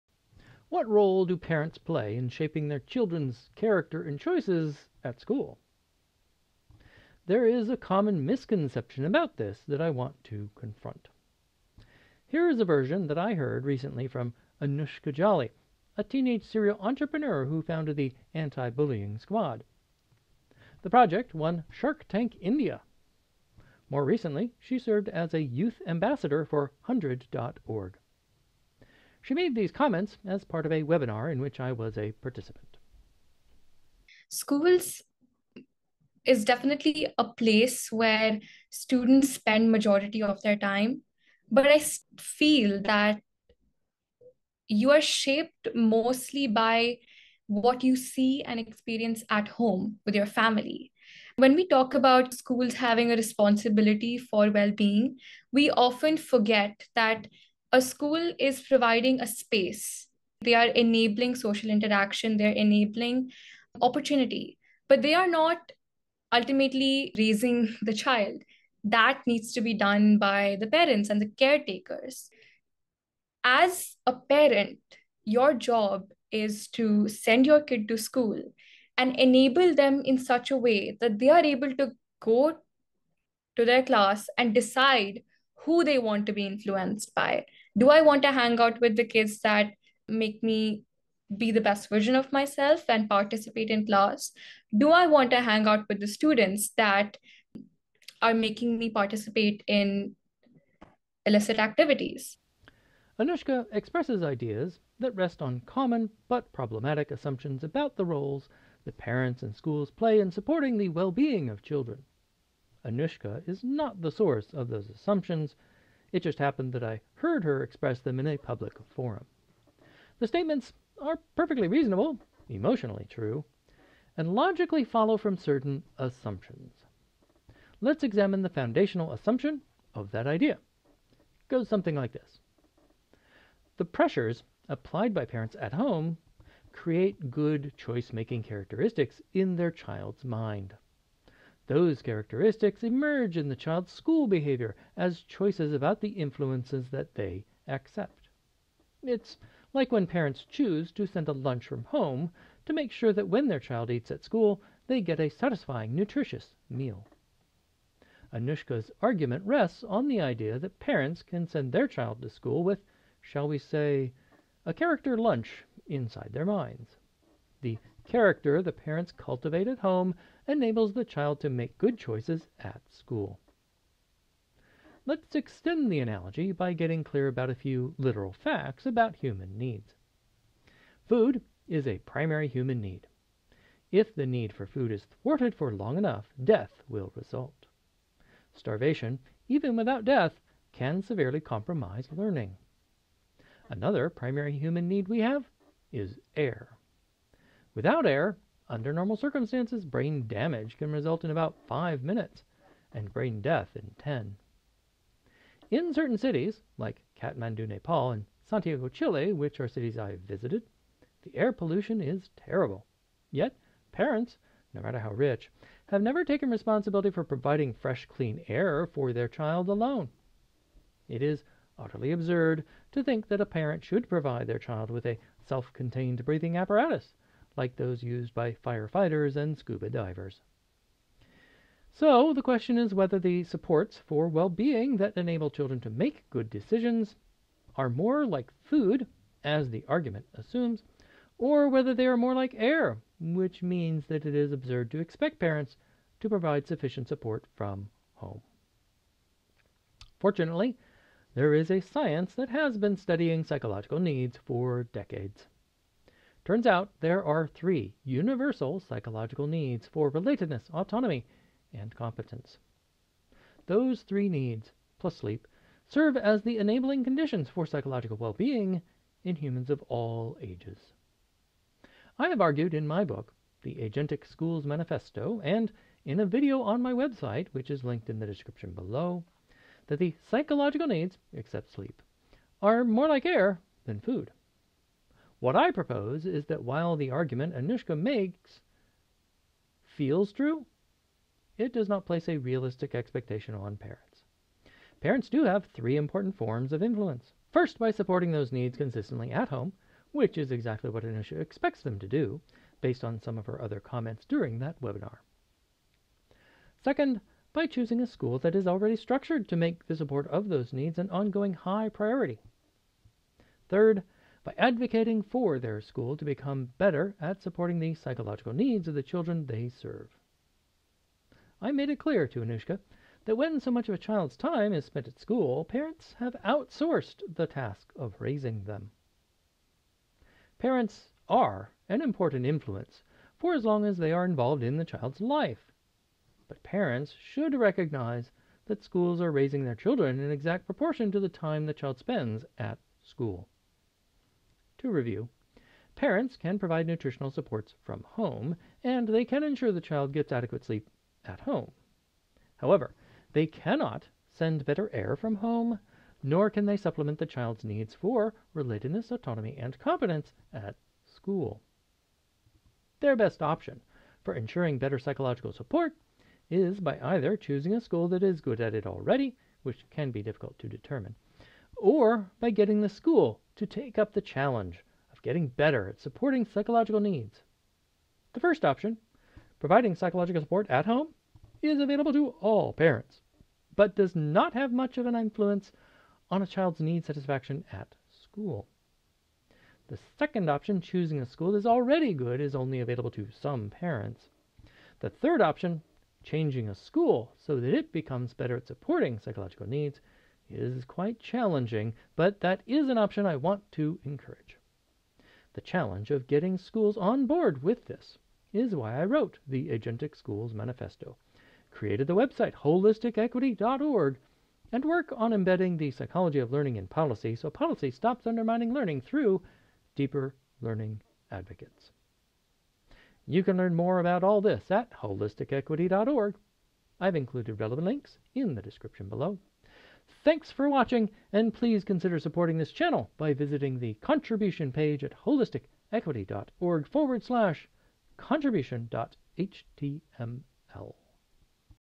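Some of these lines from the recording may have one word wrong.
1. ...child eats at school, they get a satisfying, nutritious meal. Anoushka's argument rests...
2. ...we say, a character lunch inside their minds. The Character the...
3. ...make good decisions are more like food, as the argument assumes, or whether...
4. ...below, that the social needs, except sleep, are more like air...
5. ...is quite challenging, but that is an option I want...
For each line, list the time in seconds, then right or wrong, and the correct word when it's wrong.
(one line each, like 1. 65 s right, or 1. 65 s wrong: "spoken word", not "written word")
1. 153 s right
2. 163 s right
3. 235 s right
4. 278 s wrong: "psychological", not "social"
5. 400 s right.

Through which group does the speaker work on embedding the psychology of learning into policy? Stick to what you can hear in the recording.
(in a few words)
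Deeper Learning Advocates.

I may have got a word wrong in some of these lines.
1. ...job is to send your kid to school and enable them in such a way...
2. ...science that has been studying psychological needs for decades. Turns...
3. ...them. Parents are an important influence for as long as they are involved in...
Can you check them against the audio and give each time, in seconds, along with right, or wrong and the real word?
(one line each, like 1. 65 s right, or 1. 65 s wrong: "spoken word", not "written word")
1. 75 s right
2. 251 s right
3. 328 s right.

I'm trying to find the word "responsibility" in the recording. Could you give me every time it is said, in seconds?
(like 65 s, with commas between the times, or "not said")
53 s, 216 s.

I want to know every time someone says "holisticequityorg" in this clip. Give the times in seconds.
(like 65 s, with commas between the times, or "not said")
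412 s, 424 s, 435 s.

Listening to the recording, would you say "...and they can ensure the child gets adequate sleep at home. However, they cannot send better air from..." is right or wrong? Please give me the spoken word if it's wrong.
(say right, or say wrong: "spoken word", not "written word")
right.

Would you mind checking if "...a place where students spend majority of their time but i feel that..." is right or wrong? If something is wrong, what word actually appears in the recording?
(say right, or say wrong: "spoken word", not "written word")
right.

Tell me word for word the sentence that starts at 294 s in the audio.
Parents do have three important forms of influence.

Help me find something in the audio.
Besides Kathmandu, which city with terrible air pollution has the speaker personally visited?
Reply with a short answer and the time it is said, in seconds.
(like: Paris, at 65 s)
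Santiago, Chile, at 208 s.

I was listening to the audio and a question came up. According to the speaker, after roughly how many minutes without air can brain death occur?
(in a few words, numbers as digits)
10.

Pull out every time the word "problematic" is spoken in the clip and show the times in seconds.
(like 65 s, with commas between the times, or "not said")
106 s.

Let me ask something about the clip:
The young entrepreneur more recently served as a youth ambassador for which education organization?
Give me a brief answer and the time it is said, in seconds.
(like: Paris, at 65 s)
HundrED.org, at 26 s.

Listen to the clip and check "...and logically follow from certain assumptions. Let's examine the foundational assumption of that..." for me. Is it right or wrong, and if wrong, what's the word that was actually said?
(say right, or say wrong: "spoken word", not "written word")
right.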